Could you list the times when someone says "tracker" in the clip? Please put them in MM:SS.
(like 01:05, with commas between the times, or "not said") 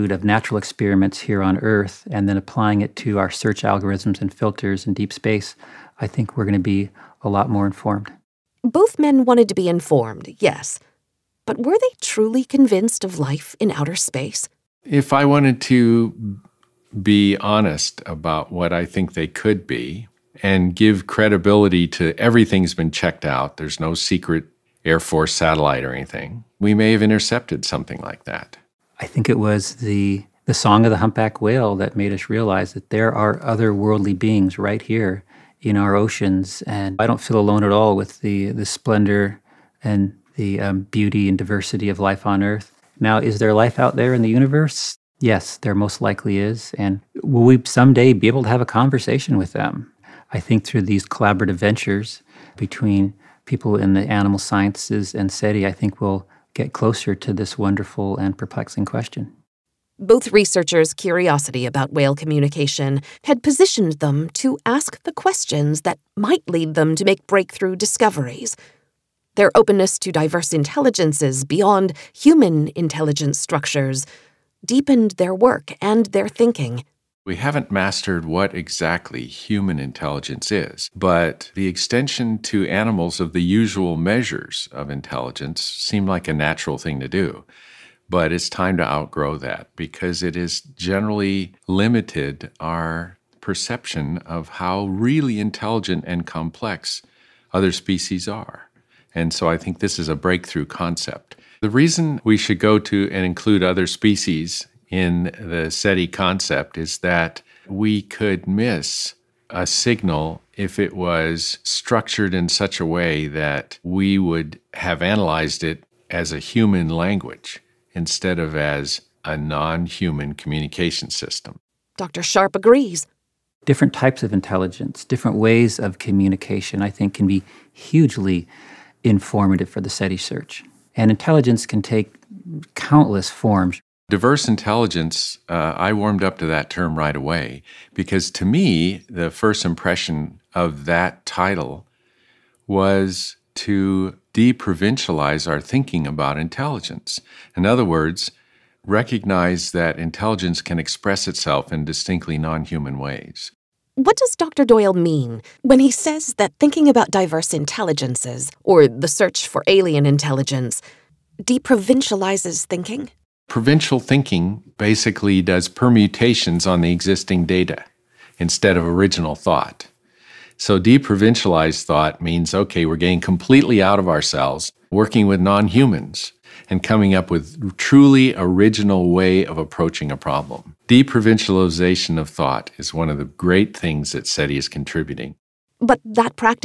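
not said.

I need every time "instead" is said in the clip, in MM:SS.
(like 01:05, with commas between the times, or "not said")
01:57, 02:48.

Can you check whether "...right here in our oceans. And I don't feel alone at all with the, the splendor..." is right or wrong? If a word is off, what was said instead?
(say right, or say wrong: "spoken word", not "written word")
right.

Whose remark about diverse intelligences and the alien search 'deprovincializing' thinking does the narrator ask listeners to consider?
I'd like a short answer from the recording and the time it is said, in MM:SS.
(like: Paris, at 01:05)
Dr. Doyle, at 02:34.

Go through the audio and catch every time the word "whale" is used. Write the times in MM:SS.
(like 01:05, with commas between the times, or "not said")
00:31, 01:01.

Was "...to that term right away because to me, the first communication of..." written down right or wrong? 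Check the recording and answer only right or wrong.
wrong.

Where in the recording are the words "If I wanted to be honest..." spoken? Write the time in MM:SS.
00:14.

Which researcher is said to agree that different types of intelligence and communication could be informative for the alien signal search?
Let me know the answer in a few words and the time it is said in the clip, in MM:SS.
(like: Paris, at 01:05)
Dr. Sharpe, at 02:01.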